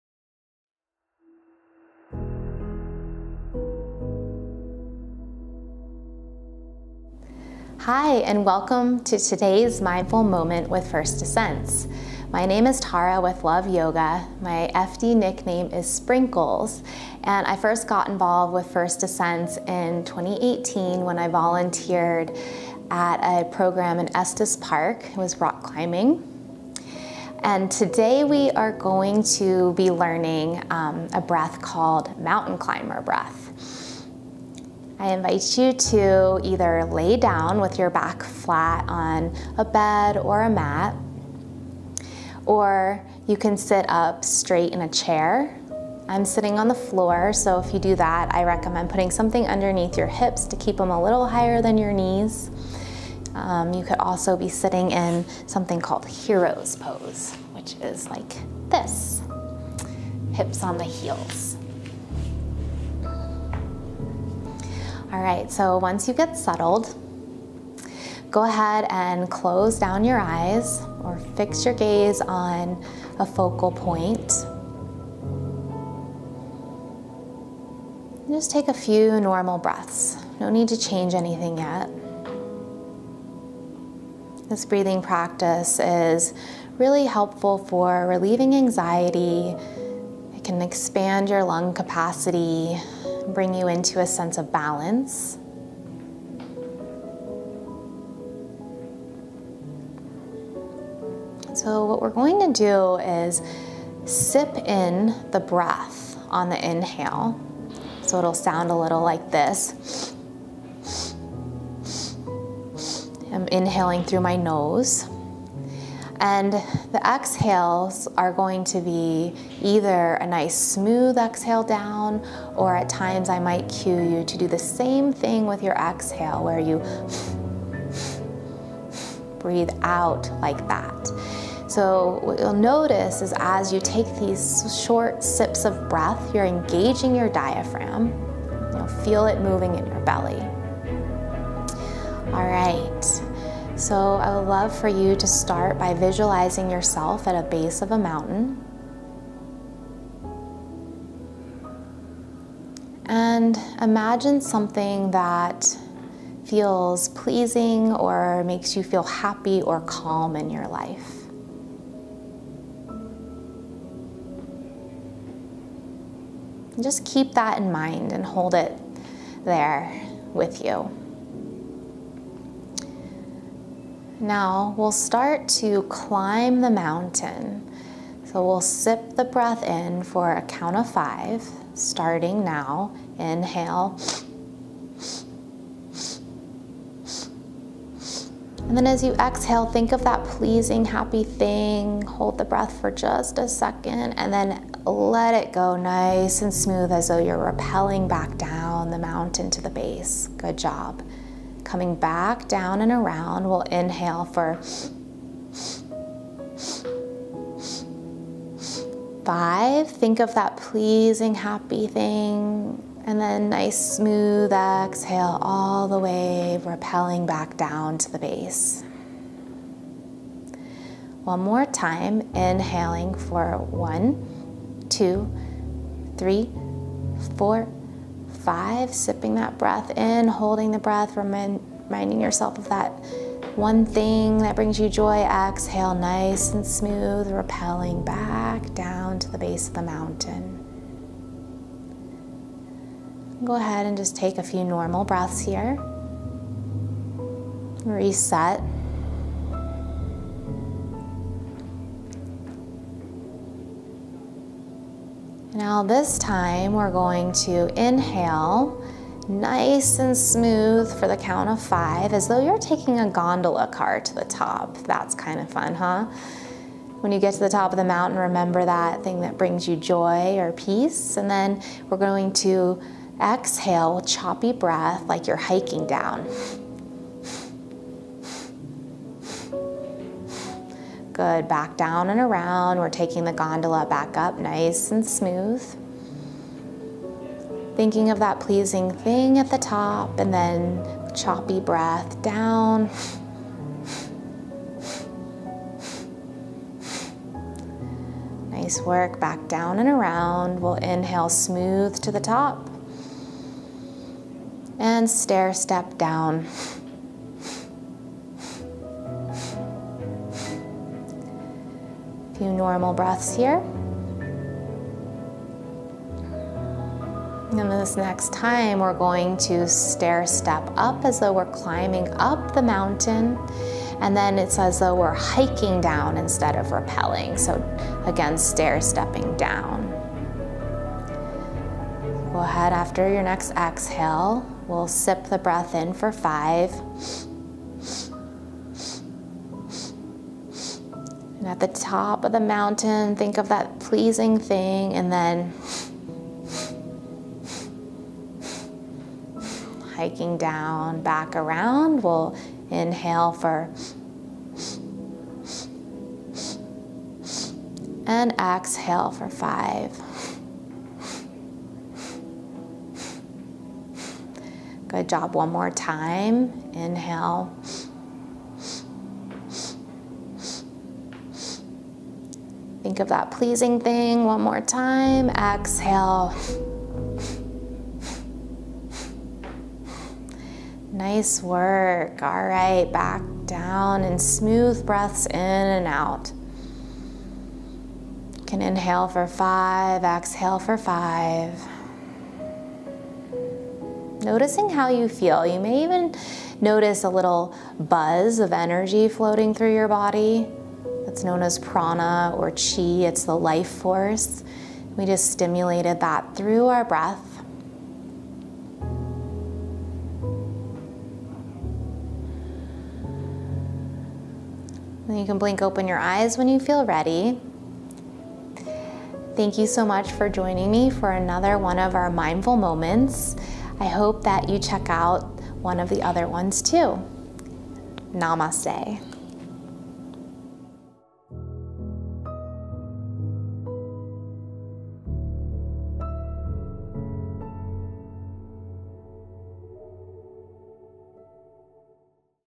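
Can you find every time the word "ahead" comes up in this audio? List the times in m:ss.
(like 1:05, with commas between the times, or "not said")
1:08, 4:03, 5:32.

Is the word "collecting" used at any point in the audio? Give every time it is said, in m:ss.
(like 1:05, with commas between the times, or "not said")
not said.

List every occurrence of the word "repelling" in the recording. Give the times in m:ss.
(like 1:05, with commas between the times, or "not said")
3:36, 3:57.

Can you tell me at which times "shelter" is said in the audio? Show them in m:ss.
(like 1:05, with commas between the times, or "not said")
not said.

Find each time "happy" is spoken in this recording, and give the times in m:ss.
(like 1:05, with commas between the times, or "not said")
2:39, 3:10, 3:31.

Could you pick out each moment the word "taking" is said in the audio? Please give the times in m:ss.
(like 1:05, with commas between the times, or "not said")
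4:22, 4:42.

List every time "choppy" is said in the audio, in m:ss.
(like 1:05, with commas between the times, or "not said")
4:34, 4:51.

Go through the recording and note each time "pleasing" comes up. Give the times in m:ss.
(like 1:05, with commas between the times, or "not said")
2:37, 3:10, 3:30, 4:48, 5:43, 6:13.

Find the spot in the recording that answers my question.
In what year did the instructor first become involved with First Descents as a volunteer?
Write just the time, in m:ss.
0:20.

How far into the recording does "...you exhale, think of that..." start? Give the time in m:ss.
3:09.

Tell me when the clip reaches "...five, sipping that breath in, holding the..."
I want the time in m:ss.
3:48.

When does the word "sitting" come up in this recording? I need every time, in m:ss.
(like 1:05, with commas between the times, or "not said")
0:46, 0:54.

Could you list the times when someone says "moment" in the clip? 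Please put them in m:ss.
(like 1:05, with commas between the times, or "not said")
0:10, 7:02.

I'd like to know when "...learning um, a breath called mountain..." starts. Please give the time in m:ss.
0:29.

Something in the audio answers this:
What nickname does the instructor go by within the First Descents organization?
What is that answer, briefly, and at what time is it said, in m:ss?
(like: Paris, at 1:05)
Sprinkles, at 0:15.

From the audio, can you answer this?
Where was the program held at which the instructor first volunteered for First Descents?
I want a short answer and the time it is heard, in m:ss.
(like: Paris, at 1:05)
Estes Park, at 0:24.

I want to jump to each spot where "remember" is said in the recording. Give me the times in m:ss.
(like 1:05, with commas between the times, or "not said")
4:28.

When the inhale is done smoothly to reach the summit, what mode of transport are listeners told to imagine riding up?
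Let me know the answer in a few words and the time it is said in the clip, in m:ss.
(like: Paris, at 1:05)
Gondola car, at 4:23.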